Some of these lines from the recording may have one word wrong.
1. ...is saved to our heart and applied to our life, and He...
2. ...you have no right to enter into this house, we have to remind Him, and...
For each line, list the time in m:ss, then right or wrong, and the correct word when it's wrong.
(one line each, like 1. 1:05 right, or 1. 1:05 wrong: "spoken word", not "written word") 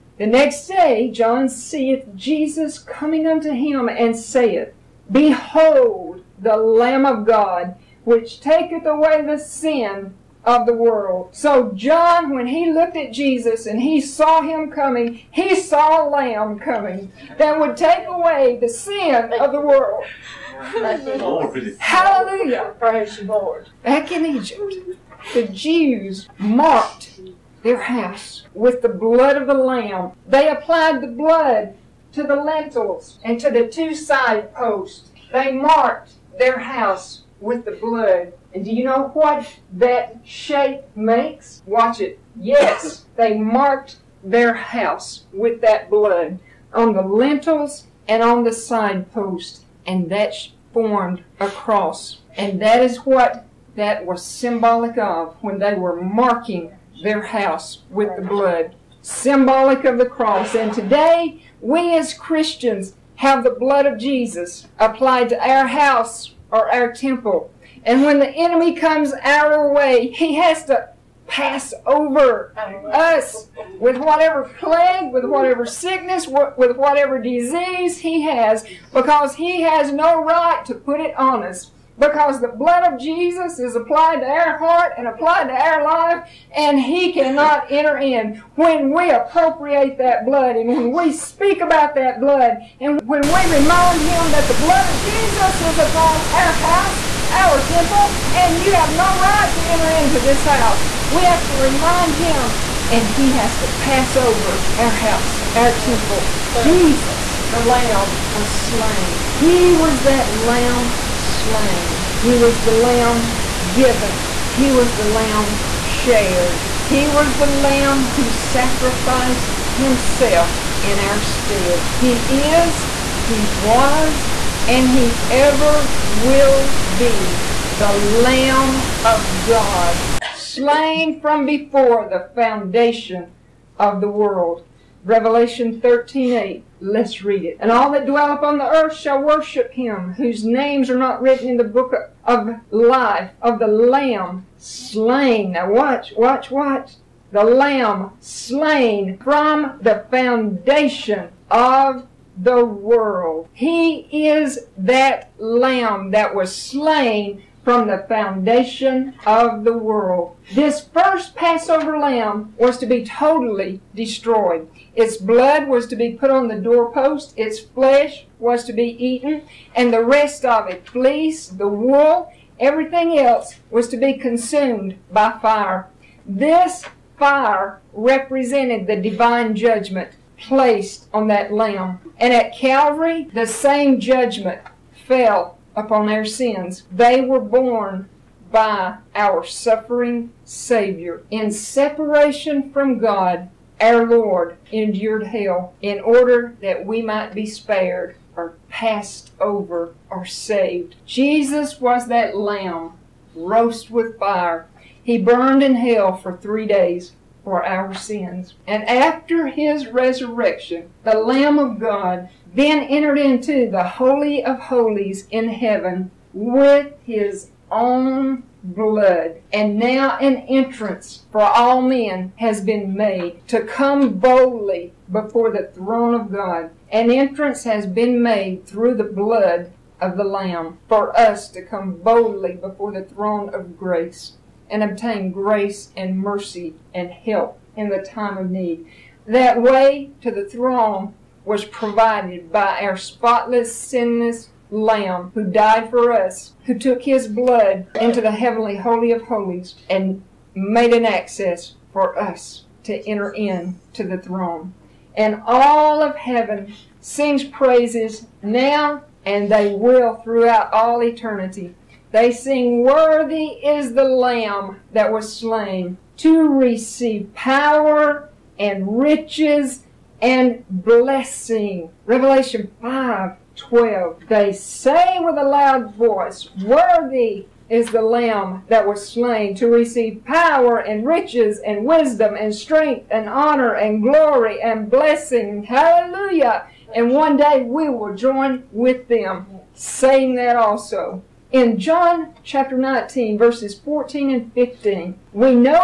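1. 1:23 wrong: "applied", not "saved"
2. 1:38 right.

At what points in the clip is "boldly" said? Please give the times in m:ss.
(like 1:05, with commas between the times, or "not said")
3:44, 3:52.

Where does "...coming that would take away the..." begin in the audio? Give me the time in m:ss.
0:16.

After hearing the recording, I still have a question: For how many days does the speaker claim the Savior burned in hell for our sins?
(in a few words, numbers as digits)
3.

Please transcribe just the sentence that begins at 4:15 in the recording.
And all of heaven sings praises now and they will throughout all eternity.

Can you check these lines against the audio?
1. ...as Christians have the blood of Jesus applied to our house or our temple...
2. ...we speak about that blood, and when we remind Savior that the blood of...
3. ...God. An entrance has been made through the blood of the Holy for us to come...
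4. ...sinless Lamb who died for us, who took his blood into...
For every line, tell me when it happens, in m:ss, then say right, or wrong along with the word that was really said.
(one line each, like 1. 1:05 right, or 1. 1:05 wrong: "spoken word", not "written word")
1. 1:01 right
2. 1:30 wrong: "Him", not "Savior"
3. 3:46 wrong: "Lamb", not "Holy"
4. 4:03 right.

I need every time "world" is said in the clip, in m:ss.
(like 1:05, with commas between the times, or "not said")
0:10, 0:19, 2:14, 2:32, 2:39.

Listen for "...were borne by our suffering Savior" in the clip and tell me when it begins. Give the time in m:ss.
3:07.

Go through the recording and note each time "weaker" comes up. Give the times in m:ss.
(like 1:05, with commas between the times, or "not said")
not said.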